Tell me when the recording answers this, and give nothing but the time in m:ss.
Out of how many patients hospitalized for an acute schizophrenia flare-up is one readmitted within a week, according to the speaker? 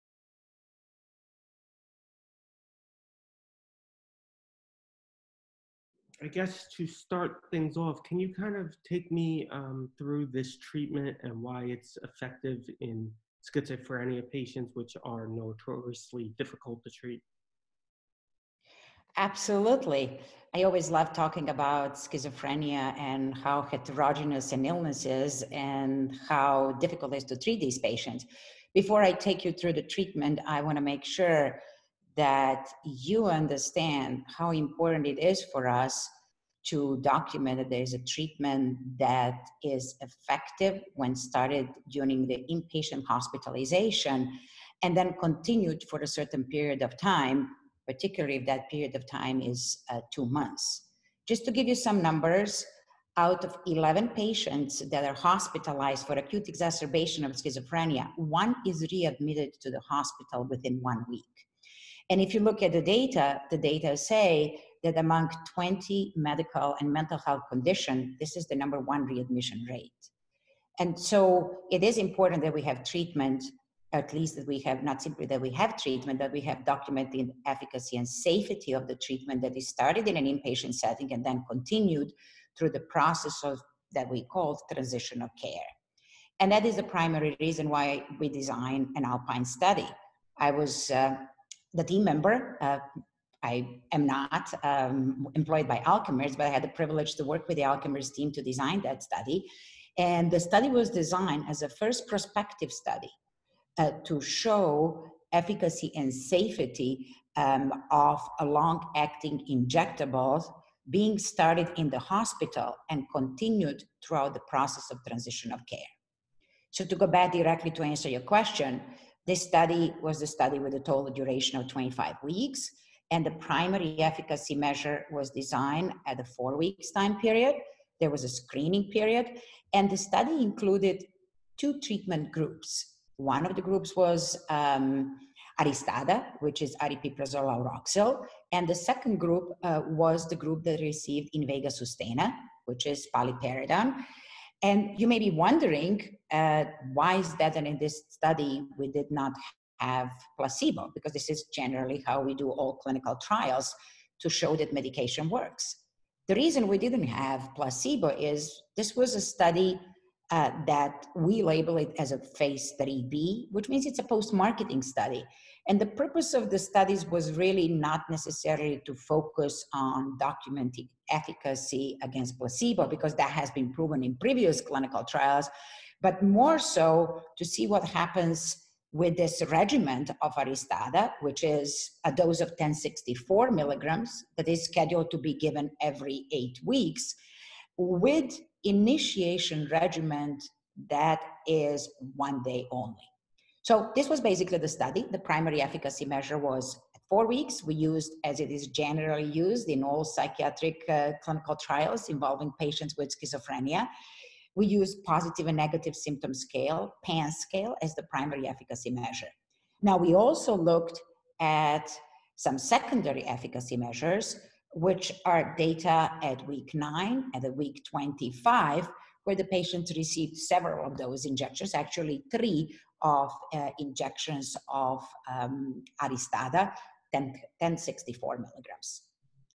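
0:53.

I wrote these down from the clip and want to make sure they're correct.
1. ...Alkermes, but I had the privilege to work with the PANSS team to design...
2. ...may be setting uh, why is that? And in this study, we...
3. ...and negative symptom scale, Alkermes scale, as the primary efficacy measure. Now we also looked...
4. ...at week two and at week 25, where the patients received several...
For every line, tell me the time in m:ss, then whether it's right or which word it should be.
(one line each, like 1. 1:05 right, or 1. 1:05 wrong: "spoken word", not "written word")
1. 1:35 wrong: "Alkermes", not "PANSS"
2. 2:25 wrong: "wondering", not "setting"
3. 3:25 wrong: "PANSS", not "Alkermes"
4. 3:36 wrong: "nine", not "two".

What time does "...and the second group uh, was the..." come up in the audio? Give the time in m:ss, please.
2:18.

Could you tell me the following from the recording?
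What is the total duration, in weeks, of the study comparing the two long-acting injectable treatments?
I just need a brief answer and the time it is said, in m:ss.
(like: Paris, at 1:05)
25 weeks, at 2:01.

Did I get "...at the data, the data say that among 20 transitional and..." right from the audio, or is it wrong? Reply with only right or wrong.
wrong.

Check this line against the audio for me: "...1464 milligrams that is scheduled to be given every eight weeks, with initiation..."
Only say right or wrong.
wrong.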